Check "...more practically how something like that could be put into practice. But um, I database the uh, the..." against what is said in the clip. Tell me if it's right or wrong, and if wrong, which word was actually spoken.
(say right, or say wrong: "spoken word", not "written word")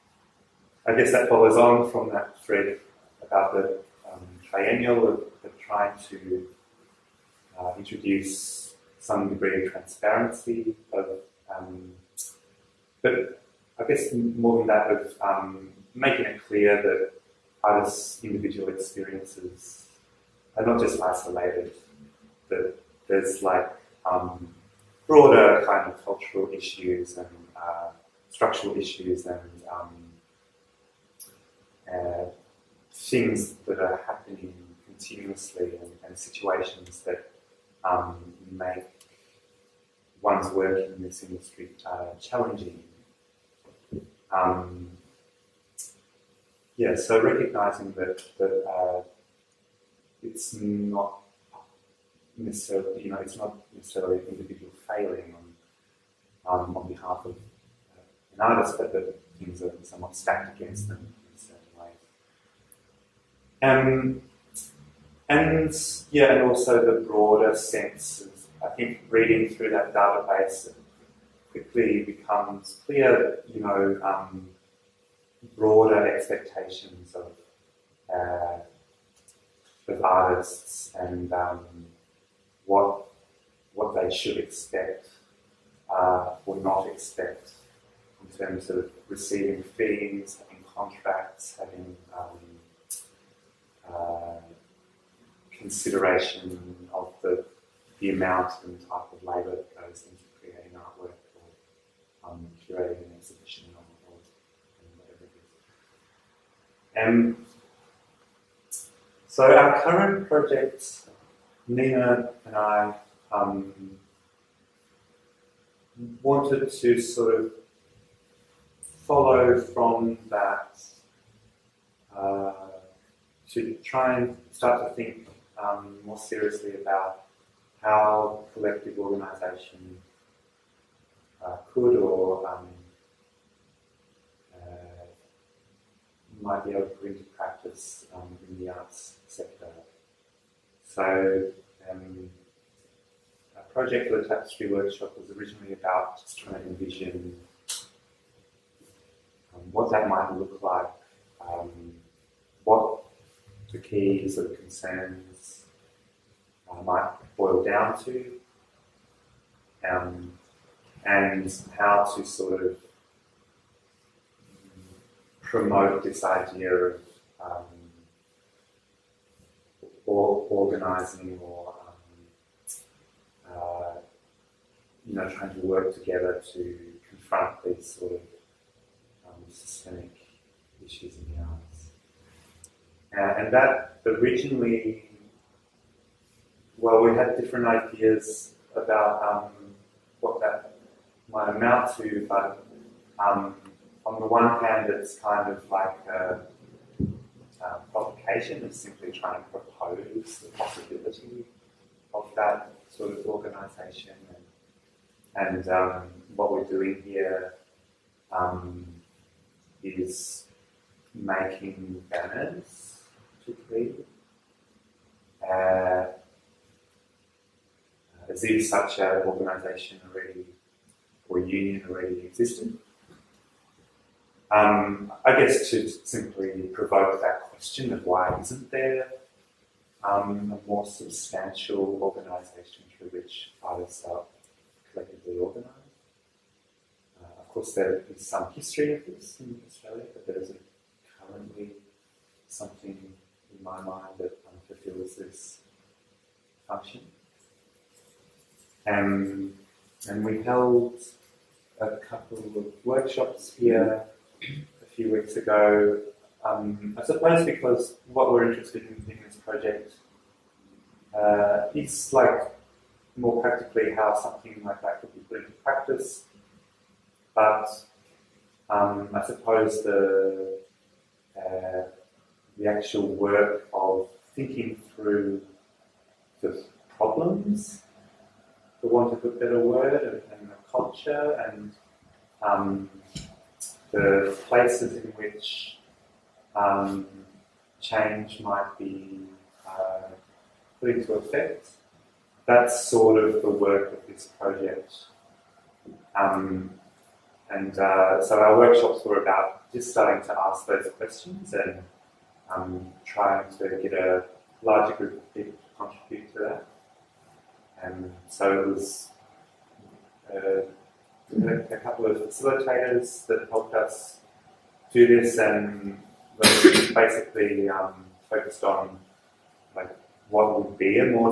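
wrong: "suppose", not "database".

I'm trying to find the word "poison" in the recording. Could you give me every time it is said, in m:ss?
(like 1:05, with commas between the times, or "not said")
not said.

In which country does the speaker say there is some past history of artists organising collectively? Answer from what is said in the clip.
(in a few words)
Australia.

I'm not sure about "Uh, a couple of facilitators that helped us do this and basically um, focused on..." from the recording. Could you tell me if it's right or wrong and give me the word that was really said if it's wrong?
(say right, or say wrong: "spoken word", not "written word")
right.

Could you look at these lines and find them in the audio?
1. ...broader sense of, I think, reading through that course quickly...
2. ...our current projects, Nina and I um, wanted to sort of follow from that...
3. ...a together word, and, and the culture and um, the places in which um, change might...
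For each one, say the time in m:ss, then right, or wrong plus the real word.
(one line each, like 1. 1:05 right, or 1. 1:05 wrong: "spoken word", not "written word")
1. 1:07 wrong: "database", not "course"
2. 1:49 right
3. 4:39 wrong: "better", not "together".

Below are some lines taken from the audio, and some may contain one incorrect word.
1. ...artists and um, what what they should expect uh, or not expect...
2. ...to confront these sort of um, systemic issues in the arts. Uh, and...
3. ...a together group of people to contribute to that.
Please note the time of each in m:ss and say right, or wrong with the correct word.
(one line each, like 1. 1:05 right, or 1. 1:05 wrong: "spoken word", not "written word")
1. 1:20 right
2. 2:56 right
3. 5:03 wrong: "larger", not "together".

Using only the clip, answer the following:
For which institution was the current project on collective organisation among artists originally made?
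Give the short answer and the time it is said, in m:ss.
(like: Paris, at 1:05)
Tapestry Workshop, at 2:24.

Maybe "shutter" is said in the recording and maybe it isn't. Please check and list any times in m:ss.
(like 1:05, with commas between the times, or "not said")
not said.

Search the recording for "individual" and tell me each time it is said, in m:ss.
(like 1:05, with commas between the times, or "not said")
0:18, 0:54.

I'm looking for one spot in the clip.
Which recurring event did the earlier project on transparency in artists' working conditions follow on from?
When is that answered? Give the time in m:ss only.
0:04.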